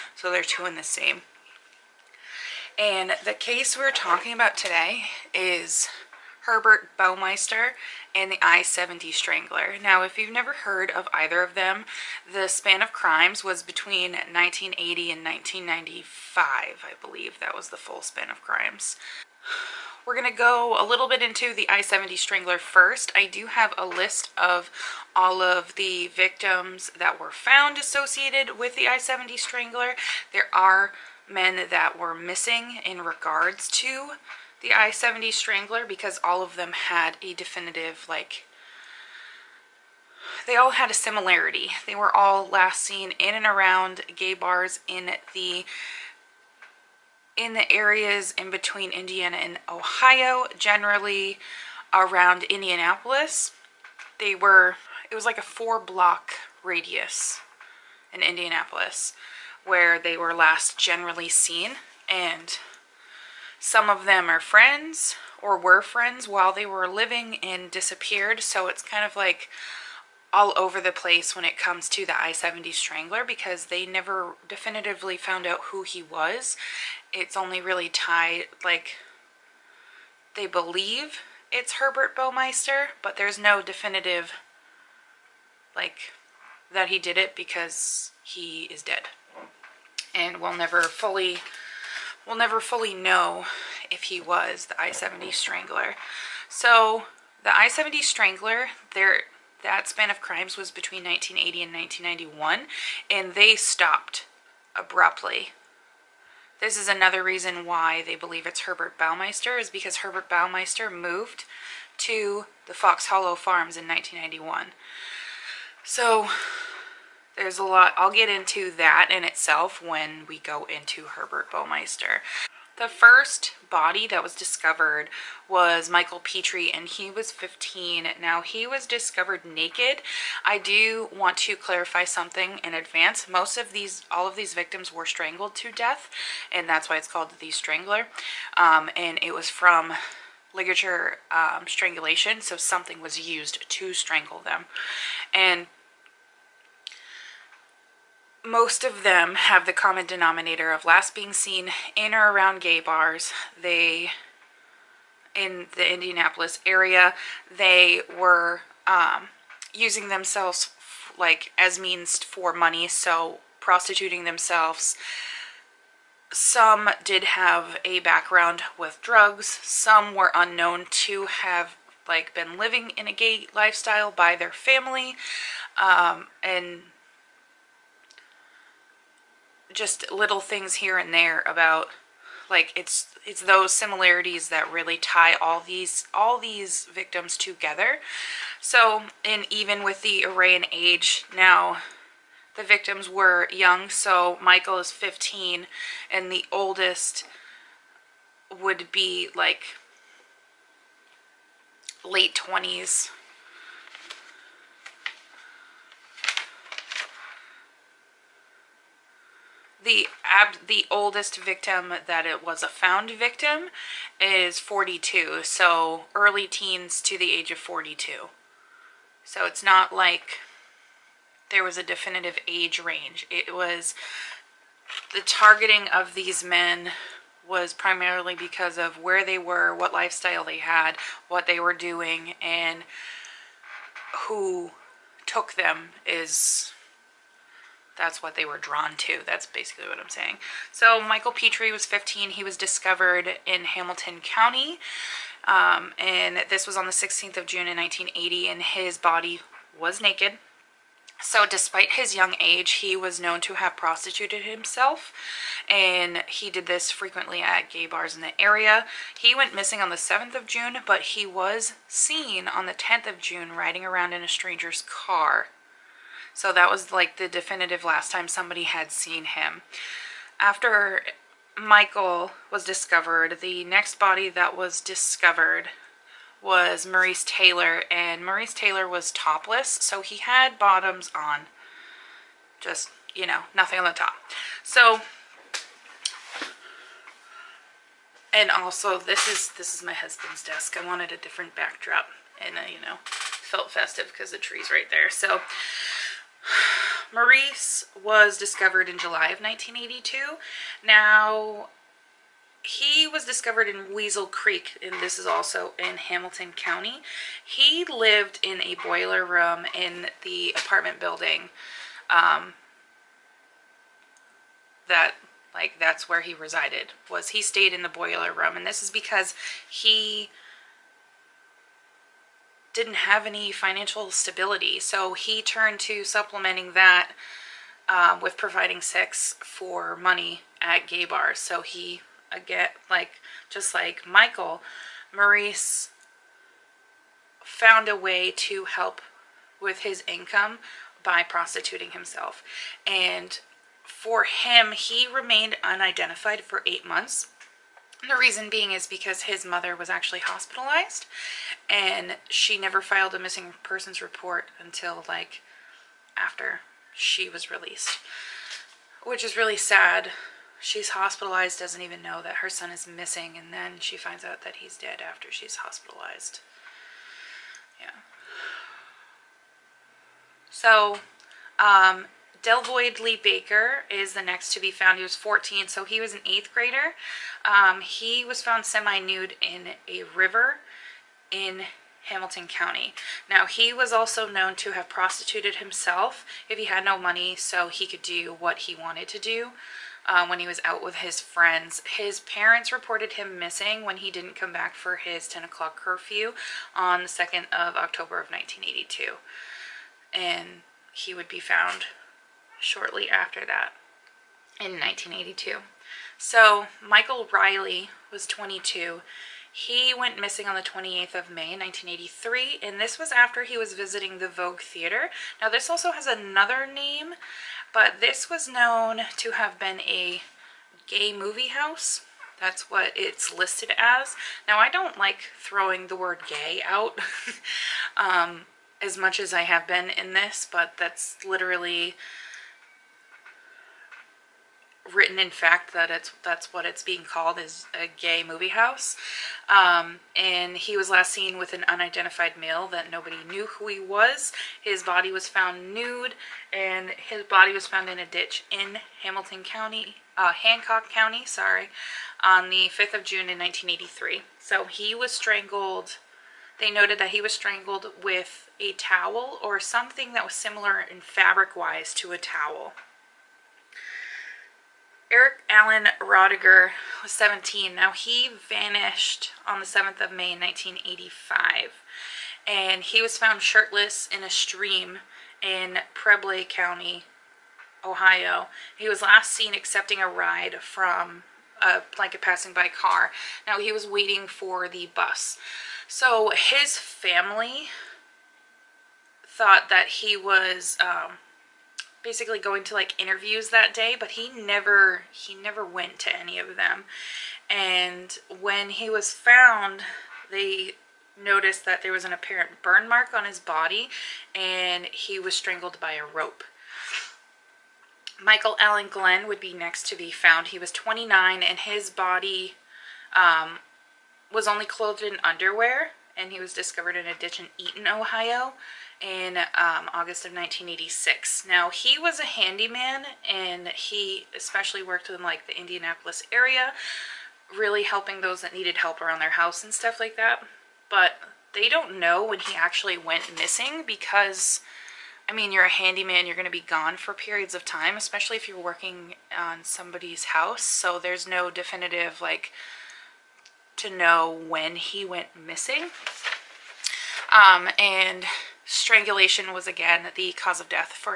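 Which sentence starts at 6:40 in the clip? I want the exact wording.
And he would be found shortly after that in 1982.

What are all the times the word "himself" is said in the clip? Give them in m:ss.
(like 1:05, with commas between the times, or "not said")
4:14, 5:41, 6:25.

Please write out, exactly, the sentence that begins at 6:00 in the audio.
She's hospitalized, doesn't even know that her son is missing, and then she finds out that he's dead after she's hospitalized.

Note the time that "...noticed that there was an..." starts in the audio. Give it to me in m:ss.
8:21.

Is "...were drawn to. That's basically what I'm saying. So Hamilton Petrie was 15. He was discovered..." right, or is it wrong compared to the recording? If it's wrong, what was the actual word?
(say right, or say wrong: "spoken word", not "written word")
wrong: "Michael", not "Hamilton".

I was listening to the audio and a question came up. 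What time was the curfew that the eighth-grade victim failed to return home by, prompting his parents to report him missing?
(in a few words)
10 o'clock.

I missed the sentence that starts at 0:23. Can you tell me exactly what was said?
I do have a list of all of the victims that were found associated with the I-70 Strangler.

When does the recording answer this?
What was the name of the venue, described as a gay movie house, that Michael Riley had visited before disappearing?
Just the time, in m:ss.
6:54.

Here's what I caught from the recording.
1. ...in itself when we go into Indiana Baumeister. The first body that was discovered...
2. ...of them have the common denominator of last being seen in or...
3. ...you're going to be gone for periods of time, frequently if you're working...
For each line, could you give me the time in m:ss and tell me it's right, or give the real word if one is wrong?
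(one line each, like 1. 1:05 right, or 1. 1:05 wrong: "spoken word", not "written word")
1. 1:59 wrong: "Herbert", not "Indiana"
2. 2:28 right
3. 8:56 wrong: "especially", not "frequently".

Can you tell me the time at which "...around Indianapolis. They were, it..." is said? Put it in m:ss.
0:51.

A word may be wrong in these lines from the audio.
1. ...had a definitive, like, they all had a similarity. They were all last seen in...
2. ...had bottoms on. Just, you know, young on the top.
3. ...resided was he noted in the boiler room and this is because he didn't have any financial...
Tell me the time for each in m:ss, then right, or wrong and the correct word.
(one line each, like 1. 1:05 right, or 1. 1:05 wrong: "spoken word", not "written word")
1. 0:36 right
2. 4:40 wrong: "nothing", not "young"
3. 5:16 wrong: "stayed", not "noted".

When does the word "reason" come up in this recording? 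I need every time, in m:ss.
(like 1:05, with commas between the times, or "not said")
1:47, 5:48.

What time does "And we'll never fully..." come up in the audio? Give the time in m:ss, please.
1:30.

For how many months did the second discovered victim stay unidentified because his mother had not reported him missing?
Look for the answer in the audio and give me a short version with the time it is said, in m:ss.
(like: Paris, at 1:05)
8, at 5:46.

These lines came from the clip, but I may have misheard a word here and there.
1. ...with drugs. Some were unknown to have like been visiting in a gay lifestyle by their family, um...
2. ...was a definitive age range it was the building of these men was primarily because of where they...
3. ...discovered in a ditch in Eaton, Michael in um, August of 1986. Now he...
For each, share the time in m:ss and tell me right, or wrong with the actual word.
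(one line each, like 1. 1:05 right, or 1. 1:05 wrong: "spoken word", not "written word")
1. 2:48 wrong: "living", not "visiting"
2. 3:41 wrong: "targeting", not "building"
3. 8:36 wrong: "Ohio", not "Michael".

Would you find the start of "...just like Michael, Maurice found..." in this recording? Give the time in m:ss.
5:33.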